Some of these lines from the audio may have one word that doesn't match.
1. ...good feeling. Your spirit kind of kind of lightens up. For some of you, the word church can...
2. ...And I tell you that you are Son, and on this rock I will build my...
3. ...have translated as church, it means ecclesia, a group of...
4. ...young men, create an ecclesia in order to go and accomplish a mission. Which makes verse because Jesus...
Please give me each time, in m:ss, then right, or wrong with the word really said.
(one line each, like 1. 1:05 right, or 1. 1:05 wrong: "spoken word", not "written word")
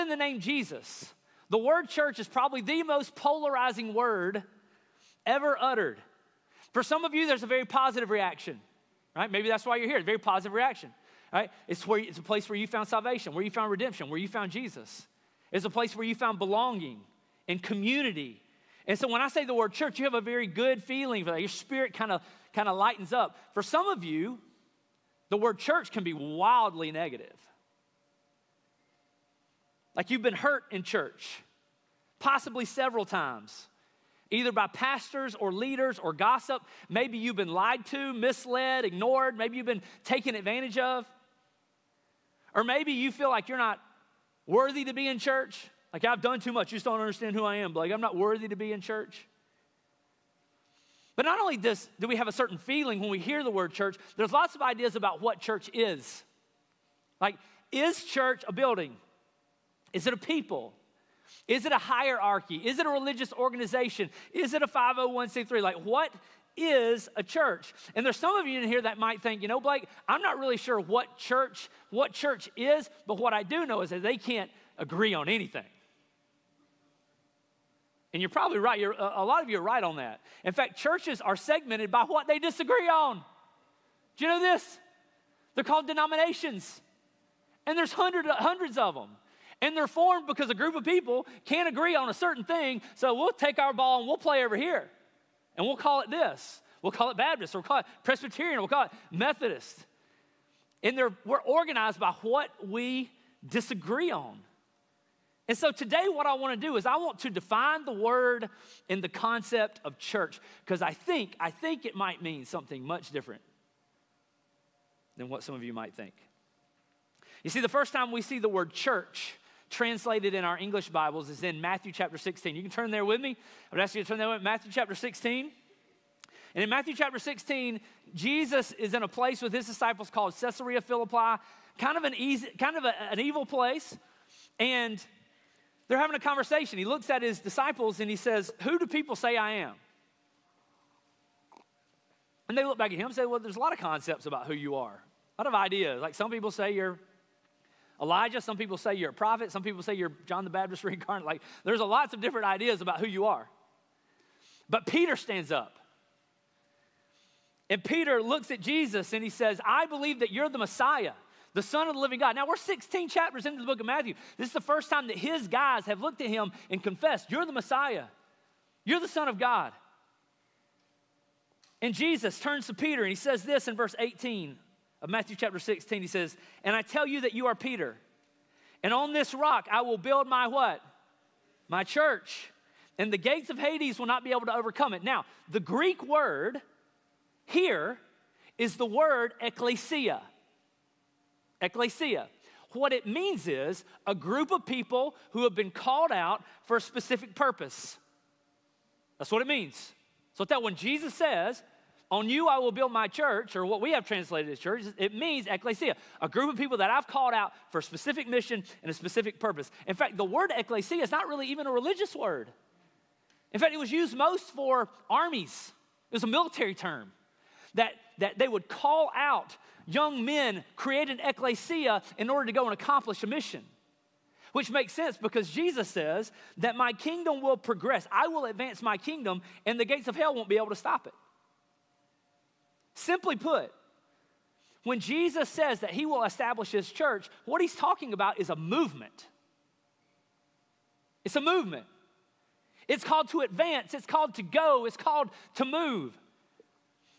1. 0:20 right
2. 2:56 wrong: "Peter", not "Son"
3. 3:23 right
4. 3:39 wrong: "sense", not "verse".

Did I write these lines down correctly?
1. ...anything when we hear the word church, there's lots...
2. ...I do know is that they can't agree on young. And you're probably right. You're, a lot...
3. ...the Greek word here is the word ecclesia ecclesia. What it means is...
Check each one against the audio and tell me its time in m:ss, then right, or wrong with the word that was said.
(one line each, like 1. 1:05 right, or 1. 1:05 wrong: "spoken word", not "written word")
1. 0:52 wrong: "feeling", not "anything"
2. 1:13 wrong: "anything", not "young"
3. 3:05 right.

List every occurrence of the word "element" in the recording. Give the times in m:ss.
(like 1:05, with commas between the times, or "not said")
not said.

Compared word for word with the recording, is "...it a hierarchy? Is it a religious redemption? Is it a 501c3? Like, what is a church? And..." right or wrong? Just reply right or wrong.
wrong.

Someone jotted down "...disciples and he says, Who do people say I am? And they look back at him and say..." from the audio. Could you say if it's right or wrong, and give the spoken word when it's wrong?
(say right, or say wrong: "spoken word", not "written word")
right.